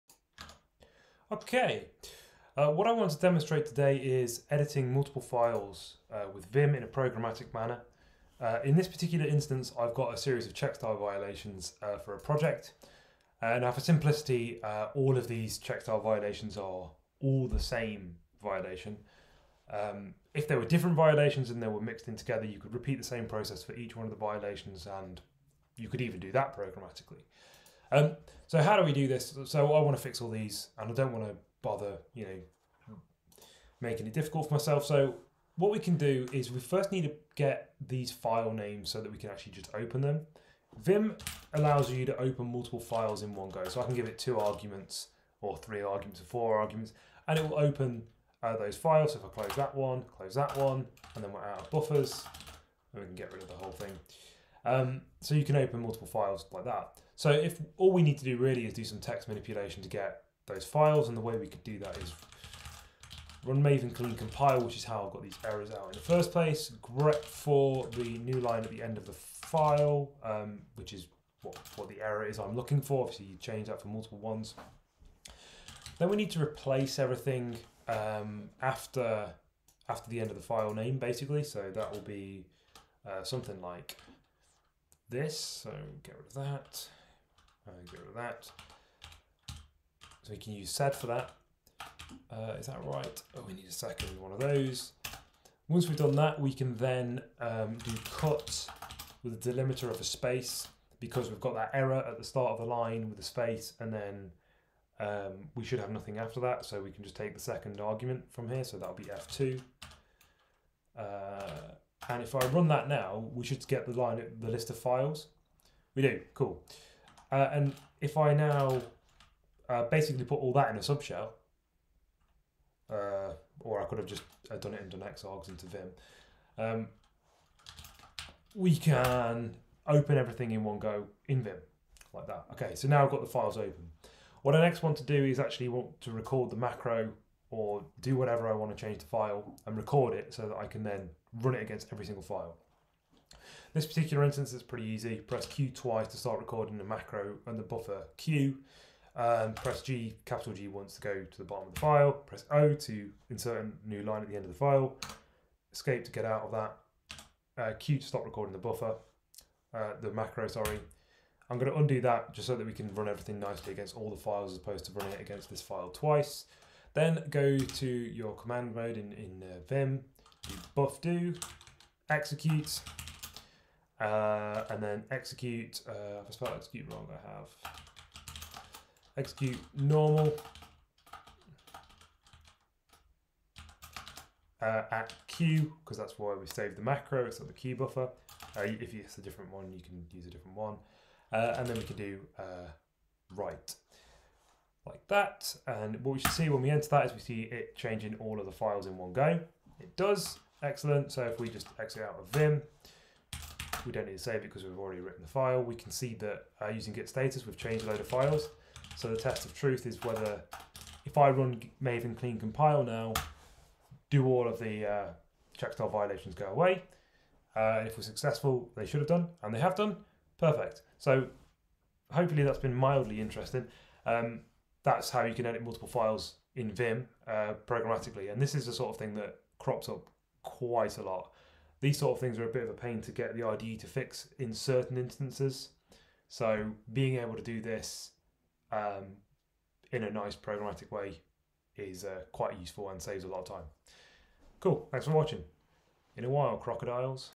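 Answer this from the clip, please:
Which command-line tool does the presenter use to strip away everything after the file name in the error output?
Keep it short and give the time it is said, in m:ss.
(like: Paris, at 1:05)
sed, at 1:30.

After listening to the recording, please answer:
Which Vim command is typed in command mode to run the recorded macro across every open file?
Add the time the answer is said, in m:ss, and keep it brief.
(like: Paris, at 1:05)
bufdo, at 2:50.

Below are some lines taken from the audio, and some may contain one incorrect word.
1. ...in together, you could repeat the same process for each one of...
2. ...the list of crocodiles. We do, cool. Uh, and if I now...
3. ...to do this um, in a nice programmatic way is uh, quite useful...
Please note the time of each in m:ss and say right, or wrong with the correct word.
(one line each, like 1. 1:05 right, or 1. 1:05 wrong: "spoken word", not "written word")
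1. 0:22 right
2. 1:54 wrong: "files", not "crocodiles"
3. 3:57 right.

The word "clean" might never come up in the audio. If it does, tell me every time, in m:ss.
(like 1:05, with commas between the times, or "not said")
1:03, 3:32.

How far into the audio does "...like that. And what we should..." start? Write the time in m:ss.
3:14.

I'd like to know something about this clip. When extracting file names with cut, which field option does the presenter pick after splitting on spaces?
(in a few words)
F2.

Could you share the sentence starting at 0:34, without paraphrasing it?
So what we can do is we first need to get these file names so that we can actually just open them.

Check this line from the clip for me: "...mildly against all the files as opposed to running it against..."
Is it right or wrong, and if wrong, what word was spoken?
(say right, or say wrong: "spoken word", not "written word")
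wrong: "nicely", not "mildly".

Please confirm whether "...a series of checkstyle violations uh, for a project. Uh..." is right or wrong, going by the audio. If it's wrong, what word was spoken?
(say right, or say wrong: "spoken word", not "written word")
right.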